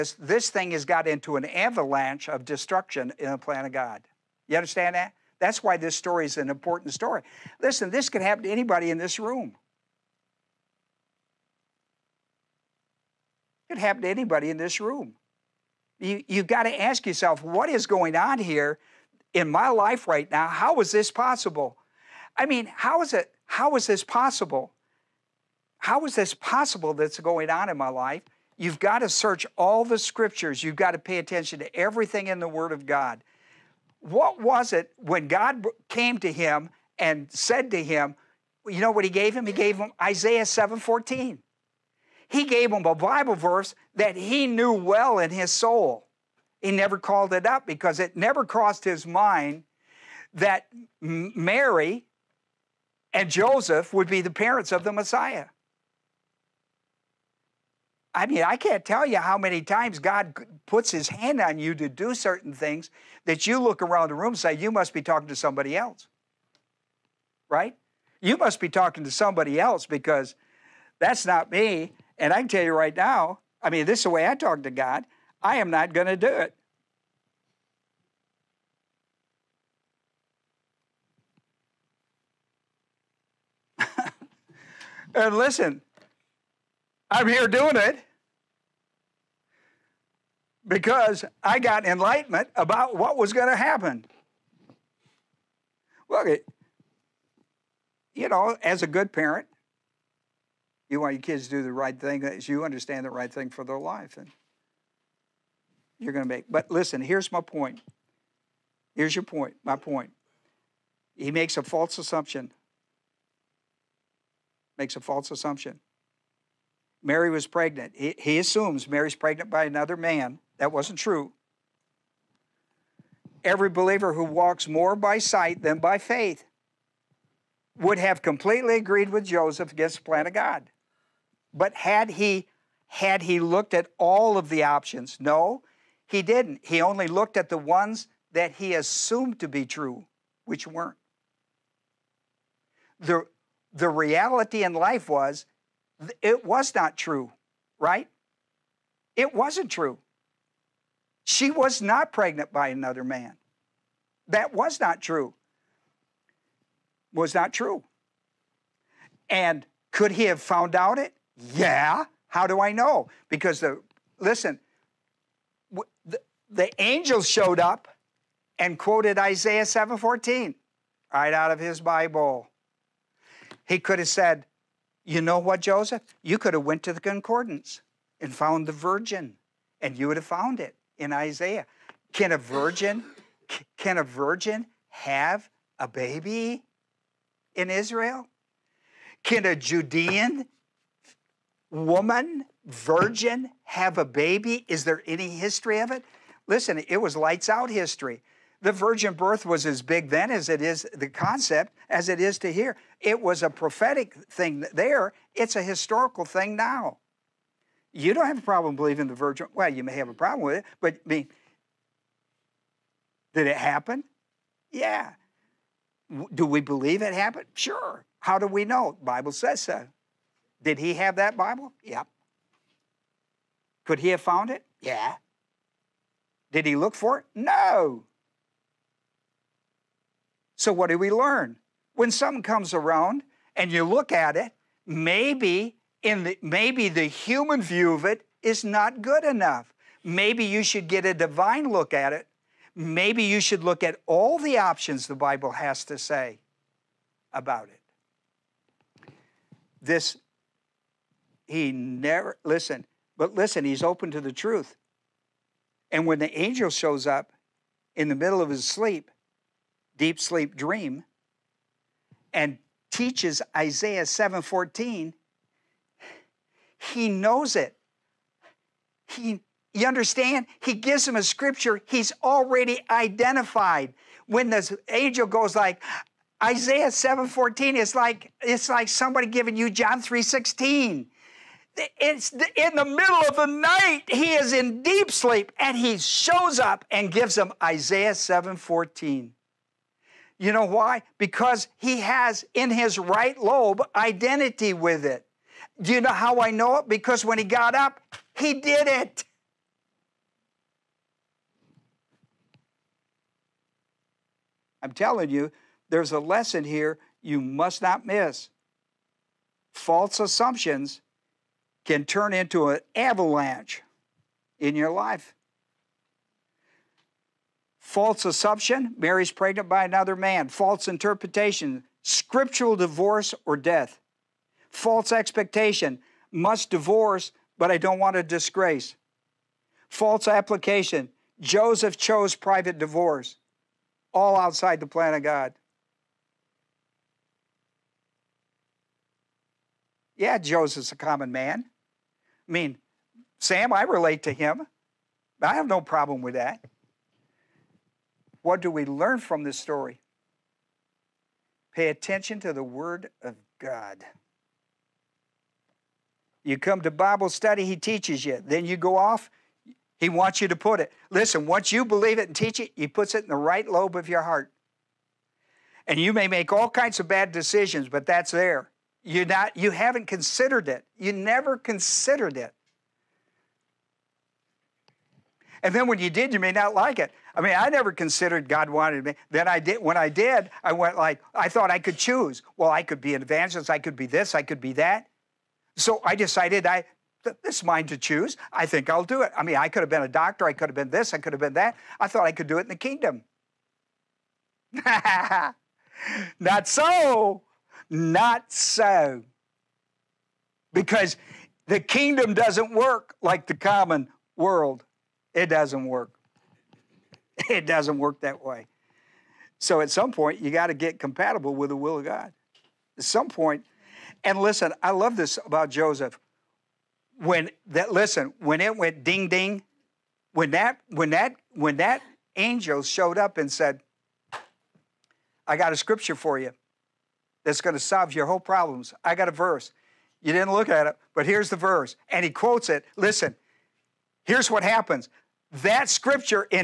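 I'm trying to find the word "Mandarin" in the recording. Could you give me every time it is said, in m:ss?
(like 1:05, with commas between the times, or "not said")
not said.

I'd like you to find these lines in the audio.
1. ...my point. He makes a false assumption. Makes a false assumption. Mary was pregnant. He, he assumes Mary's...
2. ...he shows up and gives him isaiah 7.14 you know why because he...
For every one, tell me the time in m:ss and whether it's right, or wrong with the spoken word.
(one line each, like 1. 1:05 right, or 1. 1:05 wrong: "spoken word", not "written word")
1. 1:49 right
2. 4:45 right.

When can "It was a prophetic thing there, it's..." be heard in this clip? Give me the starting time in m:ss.
3:23.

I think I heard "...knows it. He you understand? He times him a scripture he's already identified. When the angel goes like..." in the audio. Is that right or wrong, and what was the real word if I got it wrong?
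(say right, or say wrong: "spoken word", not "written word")
wrong: "gives", not "times".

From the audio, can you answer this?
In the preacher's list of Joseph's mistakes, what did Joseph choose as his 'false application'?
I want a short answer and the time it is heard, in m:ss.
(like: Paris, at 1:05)
private divorce, at 5:32.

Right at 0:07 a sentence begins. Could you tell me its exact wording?
Listen, this could happen to anybody in this room.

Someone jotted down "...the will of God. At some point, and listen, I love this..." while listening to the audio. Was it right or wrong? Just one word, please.
right.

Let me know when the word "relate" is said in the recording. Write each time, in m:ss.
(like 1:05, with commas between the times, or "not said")
5:43.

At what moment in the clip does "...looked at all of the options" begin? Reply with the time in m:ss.
2:13.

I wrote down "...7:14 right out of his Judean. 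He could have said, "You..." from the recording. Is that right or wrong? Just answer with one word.
wrong.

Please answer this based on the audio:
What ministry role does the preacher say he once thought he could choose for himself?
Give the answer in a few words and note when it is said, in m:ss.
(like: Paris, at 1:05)
evangelist, at 6:23.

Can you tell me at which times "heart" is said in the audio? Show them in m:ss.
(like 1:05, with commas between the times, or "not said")
6:04.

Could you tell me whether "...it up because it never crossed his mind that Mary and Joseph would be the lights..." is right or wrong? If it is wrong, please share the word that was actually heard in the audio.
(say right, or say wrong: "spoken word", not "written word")
wrong: "parents", not "lights".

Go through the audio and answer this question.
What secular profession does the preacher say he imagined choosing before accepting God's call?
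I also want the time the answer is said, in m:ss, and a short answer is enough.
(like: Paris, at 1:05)
doctor, at 6:30.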